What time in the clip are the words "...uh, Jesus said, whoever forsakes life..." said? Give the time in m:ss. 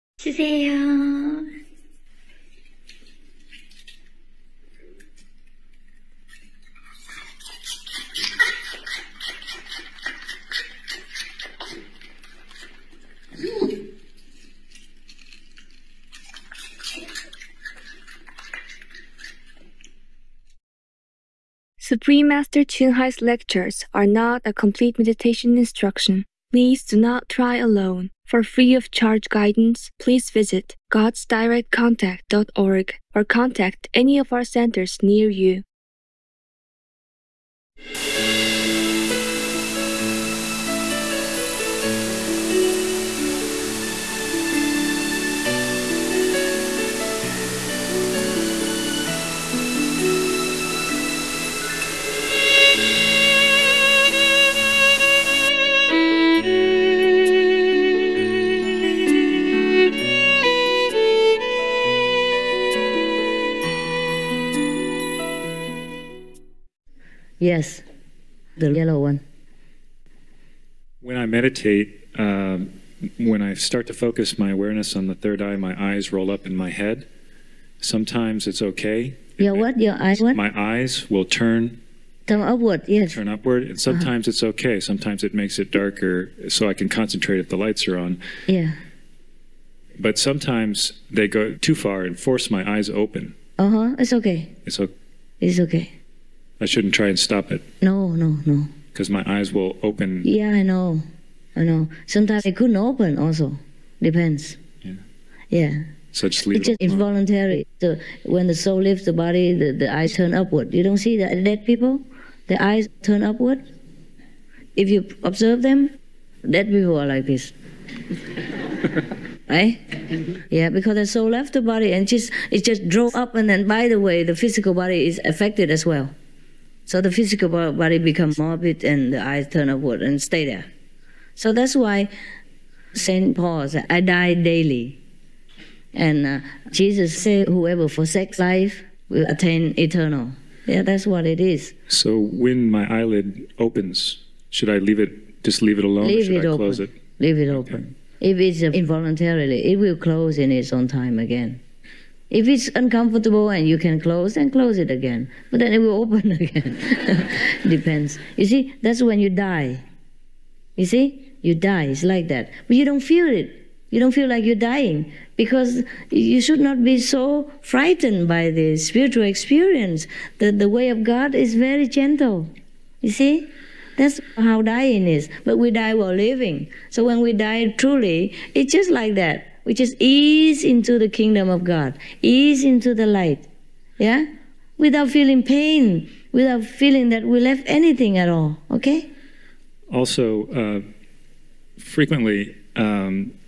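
2:16.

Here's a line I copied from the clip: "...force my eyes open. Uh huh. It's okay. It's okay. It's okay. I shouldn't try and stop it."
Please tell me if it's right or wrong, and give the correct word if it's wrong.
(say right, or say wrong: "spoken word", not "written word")
right.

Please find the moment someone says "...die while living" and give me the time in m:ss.
2:55.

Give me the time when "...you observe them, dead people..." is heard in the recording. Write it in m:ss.
1:54.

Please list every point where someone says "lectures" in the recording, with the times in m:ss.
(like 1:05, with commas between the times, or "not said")
0:23.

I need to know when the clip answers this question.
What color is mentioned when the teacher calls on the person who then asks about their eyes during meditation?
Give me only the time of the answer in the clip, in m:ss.
1:08.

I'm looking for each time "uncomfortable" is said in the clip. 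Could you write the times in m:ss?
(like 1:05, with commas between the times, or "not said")
2:32.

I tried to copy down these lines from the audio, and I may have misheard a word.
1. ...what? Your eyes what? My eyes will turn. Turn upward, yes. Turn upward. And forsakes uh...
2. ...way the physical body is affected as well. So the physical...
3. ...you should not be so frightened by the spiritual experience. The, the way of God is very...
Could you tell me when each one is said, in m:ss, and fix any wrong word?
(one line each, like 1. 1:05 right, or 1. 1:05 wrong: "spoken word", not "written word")
1. 1:19 wrong: "sometimes", not "forsakes"
2. 2:03 right
3. 2:46 right.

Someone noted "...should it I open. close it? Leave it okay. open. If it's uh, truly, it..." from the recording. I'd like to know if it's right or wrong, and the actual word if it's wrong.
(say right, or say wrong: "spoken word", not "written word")
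wrong: "involuntarily", not "truly".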